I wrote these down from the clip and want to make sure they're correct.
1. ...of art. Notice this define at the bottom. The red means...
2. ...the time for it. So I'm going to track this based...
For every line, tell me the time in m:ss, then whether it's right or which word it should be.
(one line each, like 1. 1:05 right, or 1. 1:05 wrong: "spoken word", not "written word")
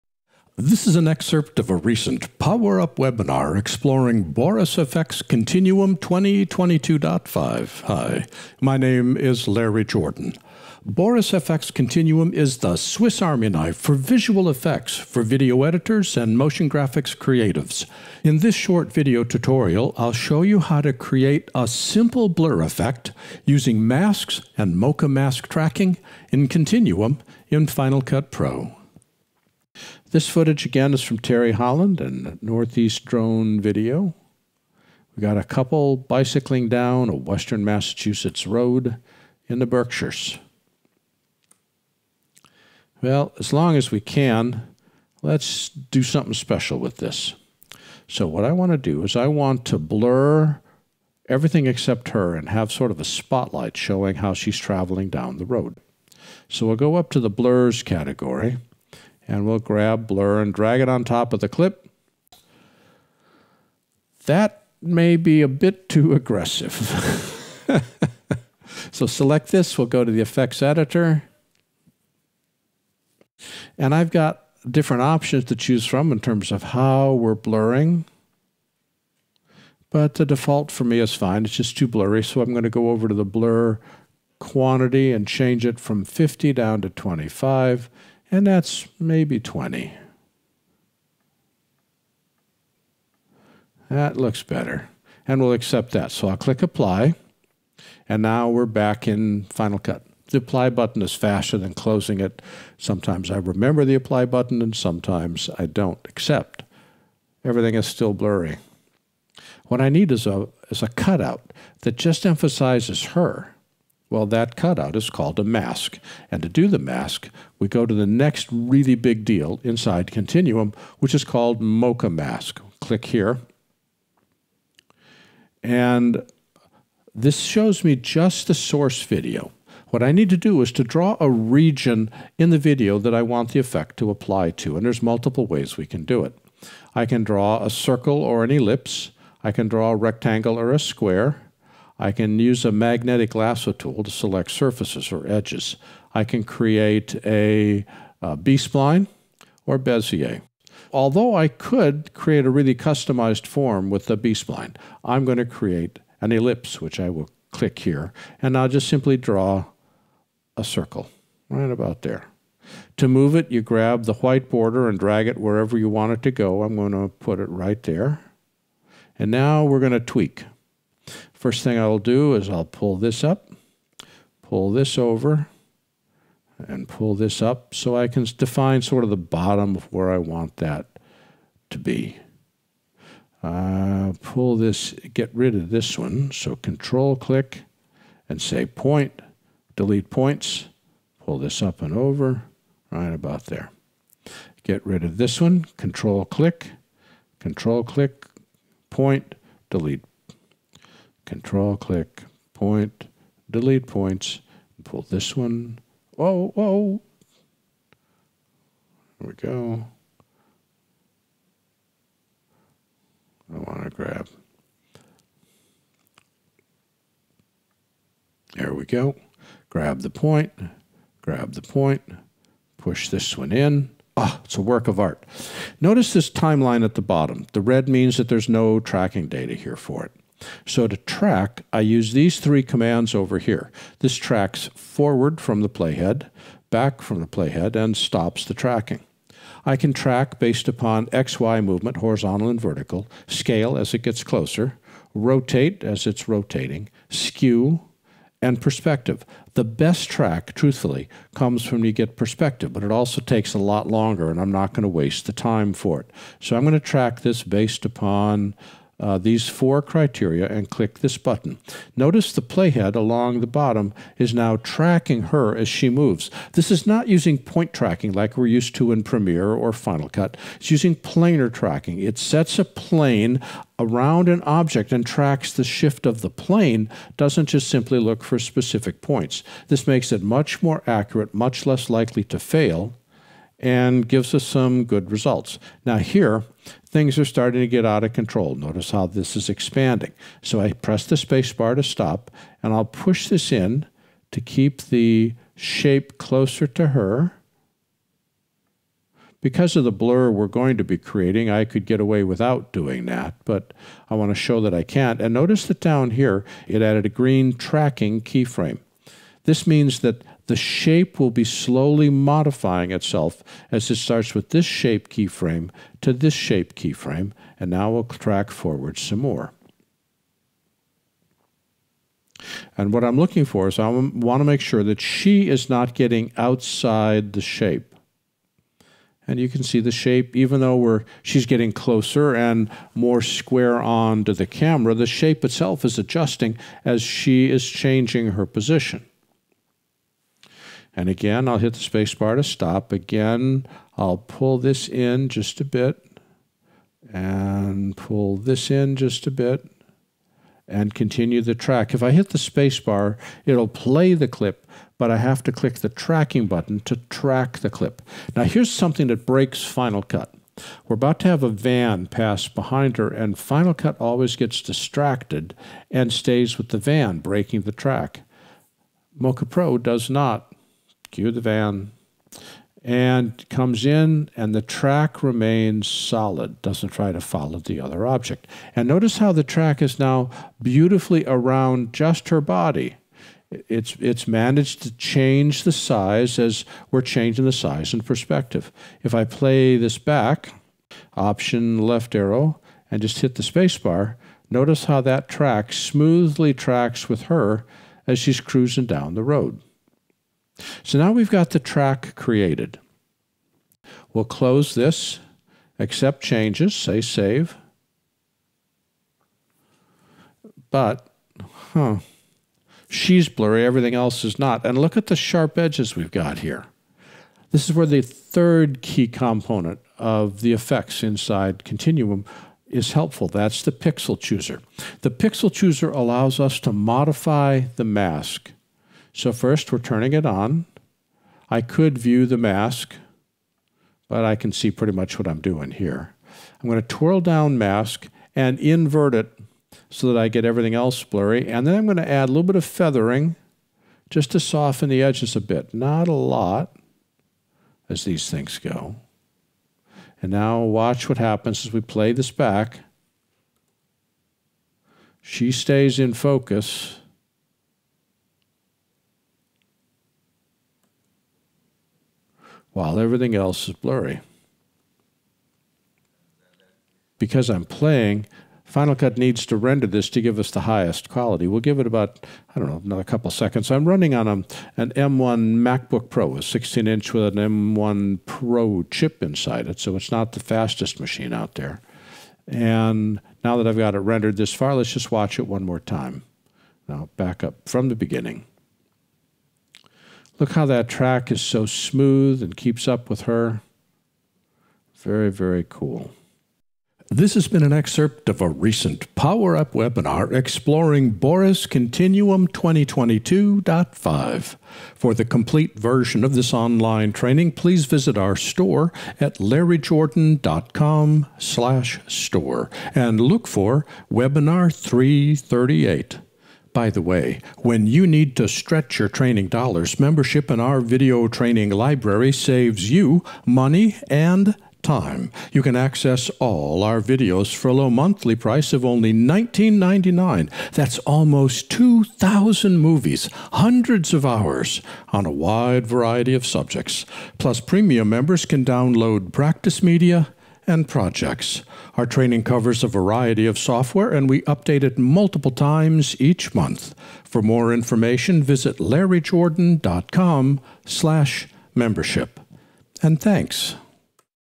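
1. 3:44 wrong: "timeline", not "define"
2. 4:15 right.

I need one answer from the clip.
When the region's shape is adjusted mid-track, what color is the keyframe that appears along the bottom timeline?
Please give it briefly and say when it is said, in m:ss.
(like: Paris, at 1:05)
Green, at 5:07.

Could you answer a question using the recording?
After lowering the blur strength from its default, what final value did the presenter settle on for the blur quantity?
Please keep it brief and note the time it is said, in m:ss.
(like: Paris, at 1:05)
20, at 1:29.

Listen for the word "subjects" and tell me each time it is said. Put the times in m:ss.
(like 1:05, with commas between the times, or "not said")
8:56.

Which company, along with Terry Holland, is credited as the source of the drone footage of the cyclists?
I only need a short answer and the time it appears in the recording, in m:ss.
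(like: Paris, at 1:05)
Northeast Drone Video, at 0:32.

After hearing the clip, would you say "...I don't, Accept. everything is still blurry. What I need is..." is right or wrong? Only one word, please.
right.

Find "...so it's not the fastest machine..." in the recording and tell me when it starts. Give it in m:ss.
7:59.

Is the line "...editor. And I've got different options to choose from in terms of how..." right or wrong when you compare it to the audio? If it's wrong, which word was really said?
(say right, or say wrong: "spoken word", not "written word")
right.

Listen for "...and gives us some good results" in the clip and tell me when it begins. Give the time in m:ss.
4:43.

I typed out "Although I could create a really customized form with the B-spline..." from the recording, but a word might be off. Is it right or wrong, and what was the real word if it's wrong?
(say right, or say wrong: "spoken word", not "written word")
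right.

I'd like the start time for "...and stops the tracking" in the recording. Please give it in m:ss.
3:57.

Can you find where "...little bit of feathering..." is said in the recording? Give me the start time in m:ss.
7:22.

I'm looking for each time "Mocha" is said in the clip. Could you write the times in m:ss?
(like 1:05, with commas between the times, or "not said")
0:24, 2:01, 6:09.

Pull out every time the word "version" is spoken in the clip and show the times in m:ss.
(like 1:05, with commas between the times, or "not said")
8:25.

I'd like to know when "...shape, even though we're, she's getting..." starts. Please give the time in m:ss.
5:29.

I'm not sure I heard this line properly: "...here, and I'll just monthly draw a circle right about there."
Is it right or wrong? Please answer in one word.
wrong.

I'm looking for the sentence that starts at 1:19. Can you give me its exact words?
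But the default for me is fine.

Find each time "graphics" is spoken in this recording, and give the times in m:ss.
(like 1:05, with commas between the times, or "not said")
0:16.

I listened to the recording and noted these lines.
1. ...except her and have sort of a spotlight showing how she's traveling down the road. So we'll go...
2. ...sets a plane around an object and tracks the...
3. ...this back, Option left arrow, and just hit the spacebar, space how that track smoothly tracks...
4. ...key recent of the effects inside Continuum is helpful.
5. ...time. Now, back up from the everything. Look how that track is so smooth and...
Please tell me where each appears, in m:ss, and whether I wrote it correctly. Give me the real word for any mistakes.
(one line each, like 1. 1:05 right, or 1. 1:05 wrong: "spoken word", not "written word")
1. 0:51 right
2. 4:32 right
3. 6:29 wrong: "notice", not "space"
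4. 6:58 wrong: "component", not "recent"
5. 8:05 wrong: "beginning", not "everything".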